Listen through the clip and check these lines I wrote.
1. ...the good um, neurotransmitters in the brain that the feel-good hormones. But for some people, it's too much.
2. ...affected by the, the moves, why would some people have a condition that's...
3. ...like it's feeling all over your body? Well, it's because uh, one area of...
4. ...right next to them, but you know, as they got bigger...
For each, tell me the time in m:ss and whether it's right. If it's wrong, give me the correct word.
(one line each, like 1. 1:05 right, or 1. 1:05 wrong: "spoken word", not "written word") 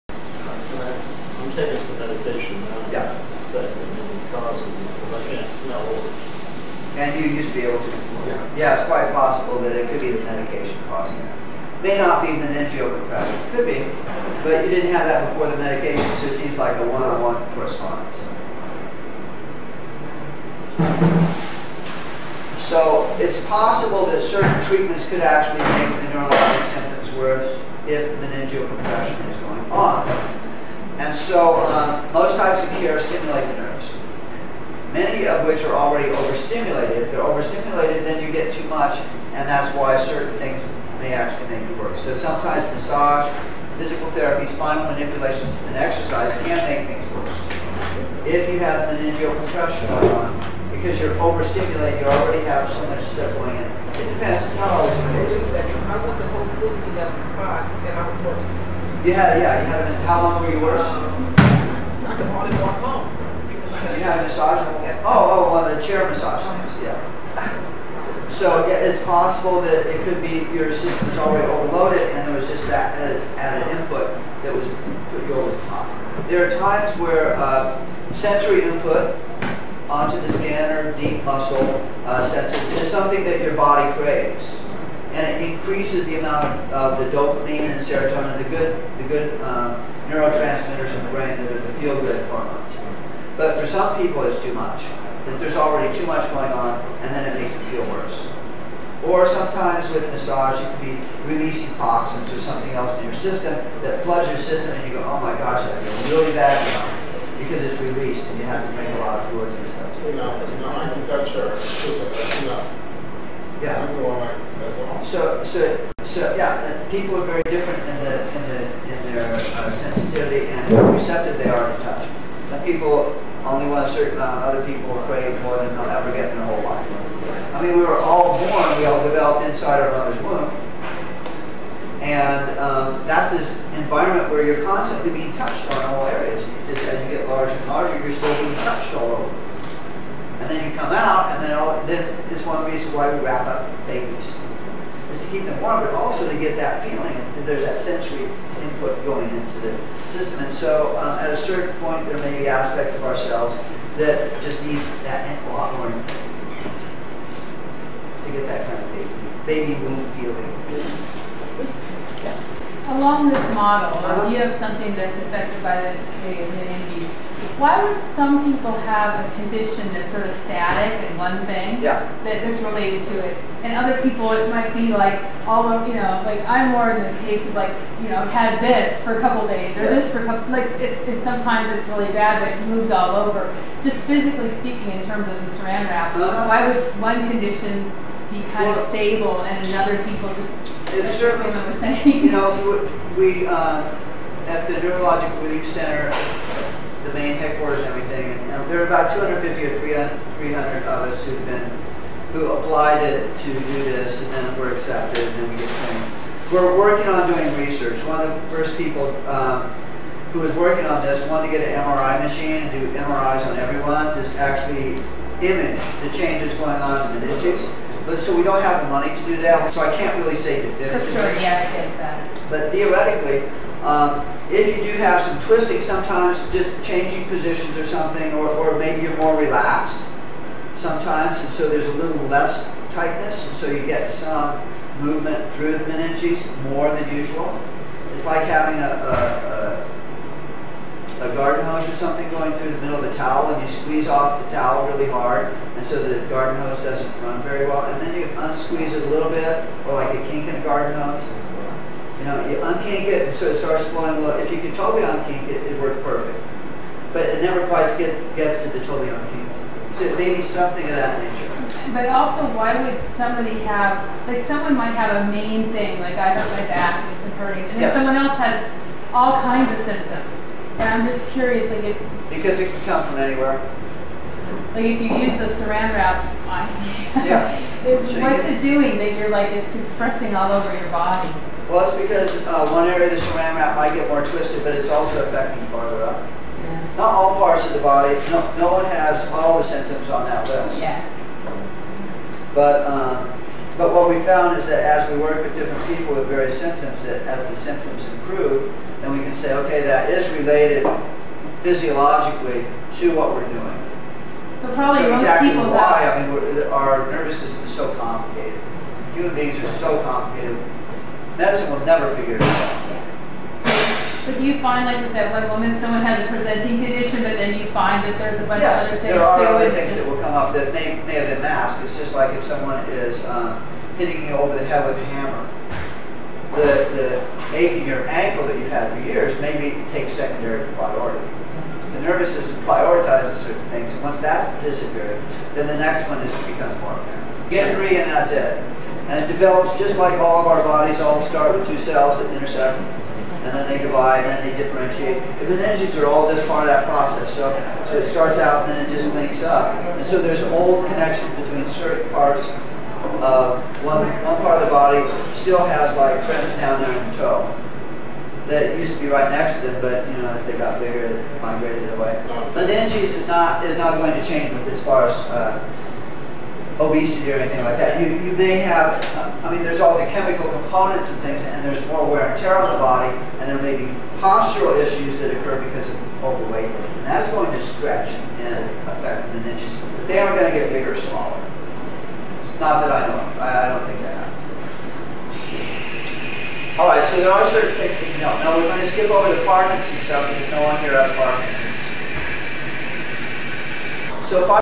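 1. 1:28 right
2. 2:45 wrong: "meninges", not "moves"
3. 4:39 wrong: "expressing", not "feeling"
4. 5:59 right.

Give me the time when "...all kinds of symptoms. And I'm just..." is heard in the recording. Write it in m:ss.
4:29.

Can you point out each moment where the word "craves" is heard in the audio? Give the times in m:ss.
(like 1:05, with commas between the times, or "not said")
1:23, 2:05.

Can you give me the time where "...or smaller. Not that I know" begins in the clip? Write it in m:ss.
6:20.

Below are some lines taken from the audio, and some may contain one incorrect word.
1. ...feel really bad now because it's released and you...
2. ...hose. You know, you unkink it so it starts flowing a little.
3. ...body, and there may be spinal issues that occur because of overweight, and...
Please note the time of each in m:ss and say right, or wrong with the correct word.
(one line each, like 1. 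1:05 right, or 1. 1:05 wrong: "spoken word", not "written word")
1. 1:45 right
2. 4:10 right
3. 6:12 wrong: "postural", not "spinal".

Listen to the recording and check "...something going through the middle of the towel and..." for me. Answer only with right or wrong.
right.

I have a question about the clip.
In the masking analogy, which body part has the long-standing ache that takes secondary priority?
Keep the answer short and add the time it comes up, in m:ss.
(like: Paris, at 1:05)
ankle, at 5:28.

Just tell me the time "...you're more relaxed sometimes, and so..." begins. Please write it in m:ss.
3:49.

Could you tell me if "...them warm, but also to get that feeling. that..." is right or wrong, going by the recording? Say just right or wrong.
right.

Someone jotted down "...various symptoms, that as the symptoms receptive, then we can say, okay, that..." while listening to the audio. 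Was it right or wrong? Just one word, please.
wrong.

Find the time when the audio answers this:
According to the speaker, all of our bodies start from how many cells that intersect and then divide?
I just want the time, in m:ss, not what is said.
5:41.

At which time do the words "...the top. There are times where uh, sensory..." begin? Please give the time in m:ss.
1:15.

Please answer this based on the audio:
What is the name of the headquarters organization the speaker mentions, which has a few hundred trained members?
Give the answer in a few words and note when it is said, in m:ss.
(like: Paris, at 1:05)
Neurologic Relief Center, at 3:14.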